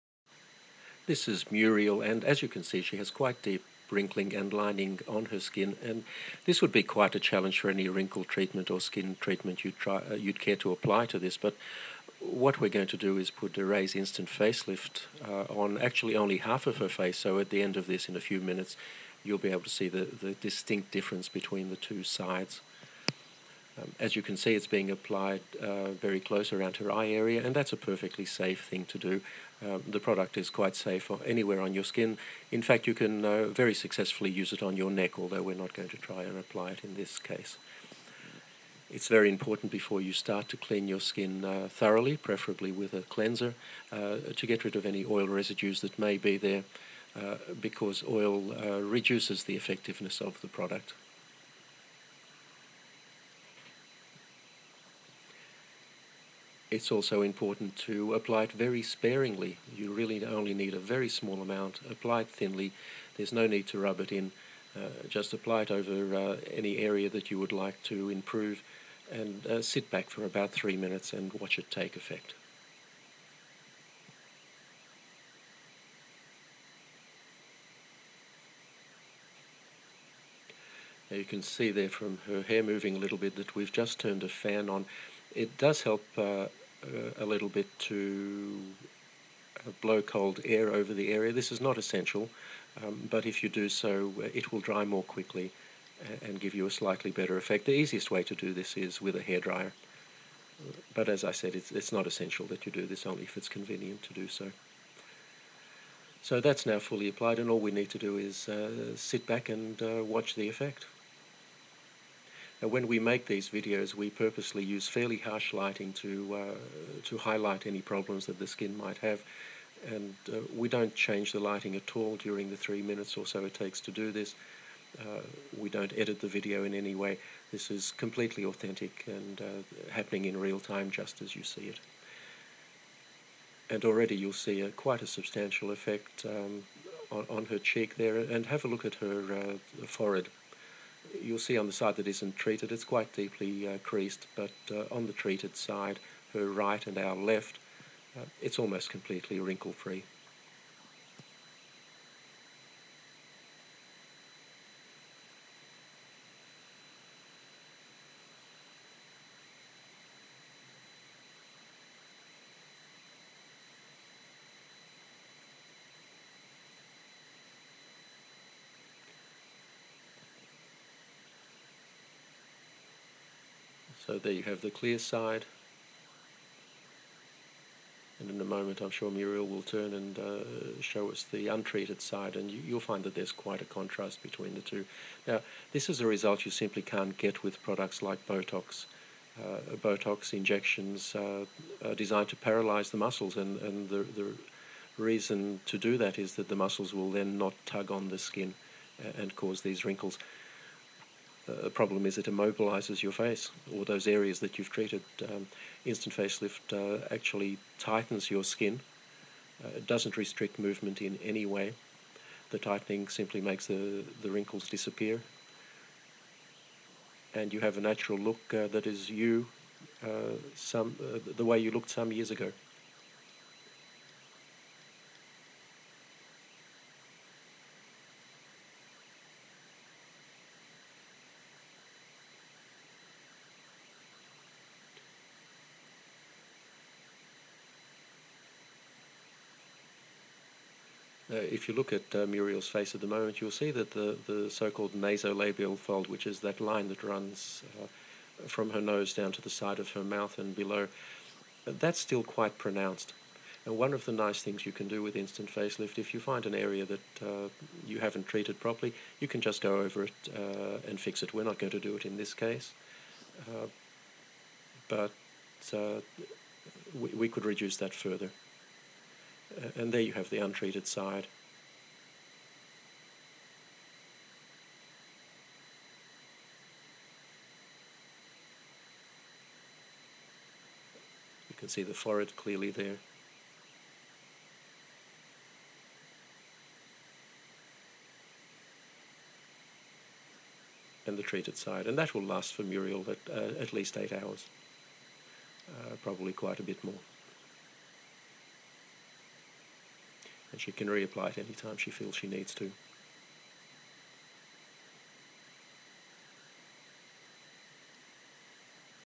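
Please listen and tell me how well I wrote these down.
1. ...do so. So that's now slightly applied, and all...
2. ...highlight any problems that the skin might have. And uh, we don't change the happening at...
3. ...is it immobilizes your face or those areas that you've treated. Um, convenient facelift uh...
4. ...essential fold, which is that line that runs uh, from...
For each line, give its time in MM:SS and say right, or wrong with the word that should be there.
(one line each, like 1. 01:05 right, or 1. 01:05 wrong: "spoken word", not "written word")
1. 01:44 wrong: "fully", not "slightly"
2. 01:57 wrong: "lighting", not "happening"
3. 03:22 wrong: "instant", not "convenient"
4. 04:04 wrong: "nasolabial", not "essential".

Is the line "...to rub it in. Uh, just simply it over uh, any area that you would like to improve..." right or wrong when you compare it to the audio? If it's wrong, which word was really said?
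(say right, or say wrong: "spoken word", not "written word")
wrong: "apply", not "simply".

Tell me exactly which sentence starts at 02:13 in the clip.
And already you'll see a, quite a substantial effect um, on, on, her cheek there.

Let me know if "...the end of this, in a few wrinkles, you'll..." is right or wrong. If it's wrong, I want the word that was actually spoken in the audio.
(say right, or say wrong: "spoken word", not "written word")
wrong: "minutes", not "wrinkles".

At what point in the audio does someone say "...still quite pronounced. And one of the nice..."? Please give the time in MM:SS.
04:11.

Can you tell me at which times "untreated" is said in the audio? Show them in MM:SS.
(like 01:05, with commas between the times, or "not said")
03:01, 04:30.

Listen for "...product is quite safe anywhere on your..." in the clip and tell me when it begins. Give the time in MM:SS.
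00:29.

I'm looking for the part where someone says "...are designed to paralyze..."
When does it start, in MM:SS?
03:11.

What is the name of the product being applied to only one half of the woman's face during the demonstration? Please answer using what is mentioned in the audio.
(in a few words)
Ray's Instant Facelift.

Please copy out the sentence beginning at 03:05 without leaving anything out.
Now, this is a result you simply can't get with products like Botox.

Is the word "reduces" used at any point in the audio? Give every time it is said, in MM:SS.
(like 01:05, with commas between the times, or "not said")
00:48, 04:27.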